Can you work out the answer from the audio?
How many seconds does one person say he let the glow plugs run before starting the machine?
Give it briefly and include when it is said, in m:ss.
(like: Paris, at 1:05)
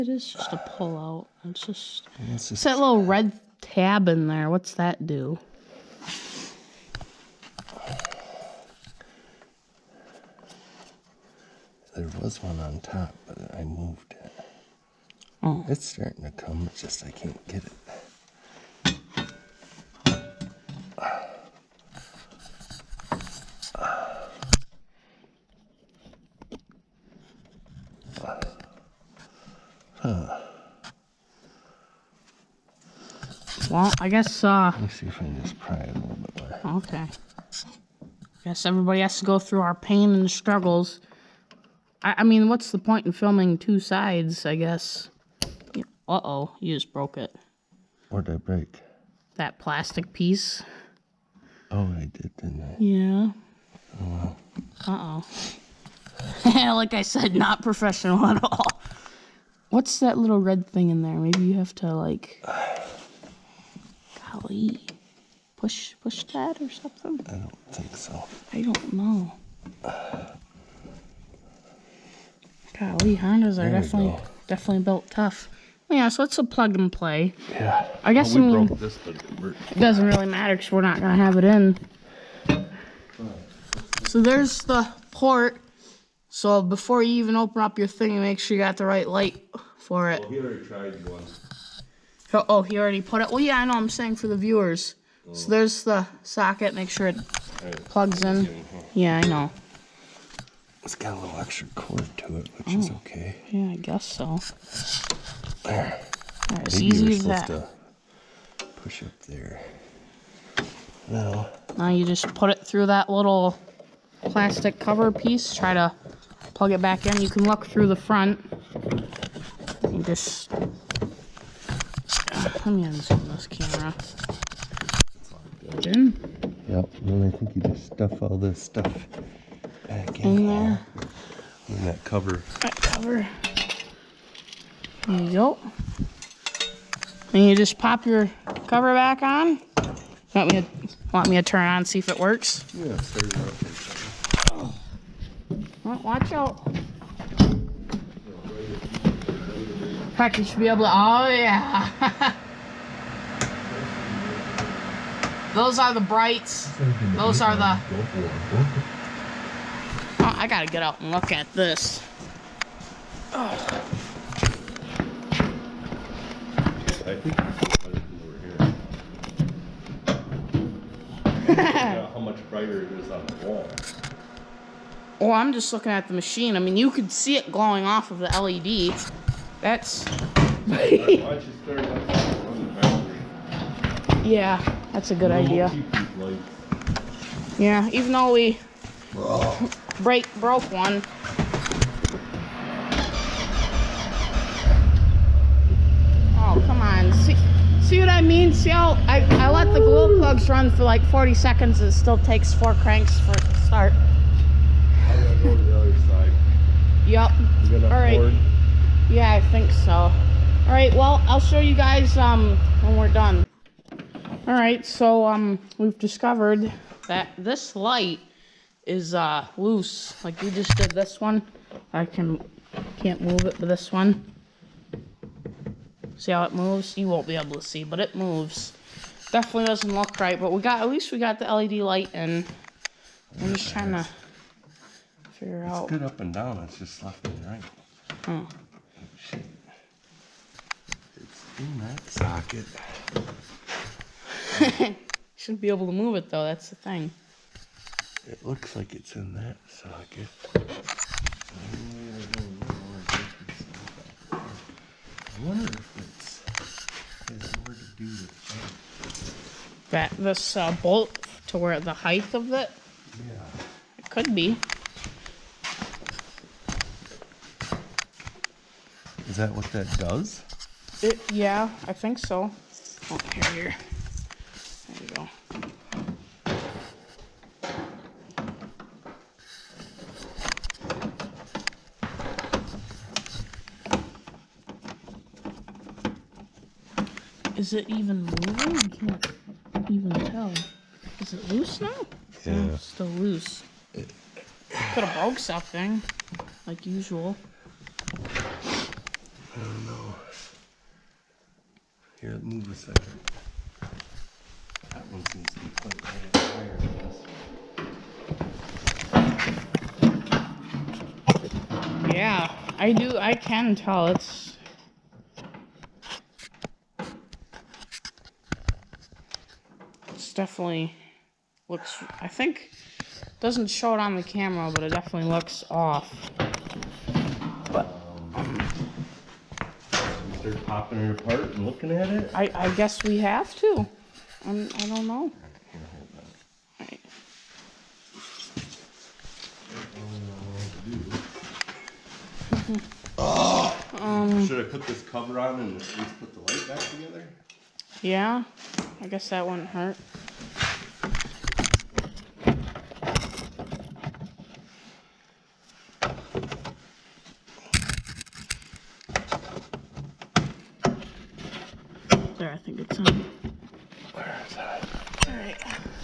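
40, at 3:21.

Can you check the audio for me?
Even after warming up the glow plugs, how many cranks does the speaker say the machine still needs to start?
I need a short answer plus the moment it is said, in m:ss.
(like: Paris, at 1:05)
4, at 3:22.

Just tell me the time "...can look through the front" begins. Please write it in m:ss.
1:57.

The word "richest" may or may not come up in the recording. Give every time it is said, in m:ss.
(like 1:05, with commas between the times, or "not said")
not said.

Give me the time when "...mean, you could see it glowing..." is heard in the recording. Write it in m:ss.
2:56.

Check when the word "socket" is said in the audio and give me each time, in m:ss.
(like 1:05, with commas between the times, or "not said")
1:36, 4:02, 4:09.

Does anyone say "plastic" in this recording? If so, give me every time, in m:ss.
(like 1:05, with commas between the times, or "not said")
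0:49, 1:54.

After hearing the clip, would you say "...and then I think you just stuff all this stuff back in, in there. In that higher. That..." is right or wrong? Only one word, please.
wrong.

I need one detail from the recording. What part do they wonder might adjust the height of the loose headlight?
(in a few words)
bolt.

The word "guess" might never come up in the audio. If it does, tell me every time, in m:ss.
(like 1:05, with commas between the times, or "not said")
0:34, 0:38, 0:44, 1:18, 1:43, 5:32, 5:49.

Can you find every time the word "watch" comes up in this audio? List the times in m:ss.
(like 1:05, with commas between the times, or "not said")
2:26.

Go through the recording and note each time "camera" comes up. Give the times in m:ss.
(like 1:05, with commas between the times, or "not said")
2:03, 5:24.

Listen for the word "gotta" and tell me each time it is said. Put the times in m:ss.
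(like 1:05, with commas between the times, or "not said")
2:40, 3:25.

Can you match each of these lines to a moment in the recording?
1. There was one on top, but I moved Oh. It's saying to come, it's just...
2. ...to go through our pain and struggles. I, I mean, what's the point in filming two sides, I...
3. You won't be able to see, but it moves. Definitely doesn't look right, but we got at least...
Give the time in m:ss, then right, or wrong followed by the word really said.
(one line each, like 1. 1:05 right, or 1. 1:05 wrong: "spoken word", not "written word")
1. 0:11 wrong: "starting", not "saying"
2. 0:39 right
3. 3:46 right.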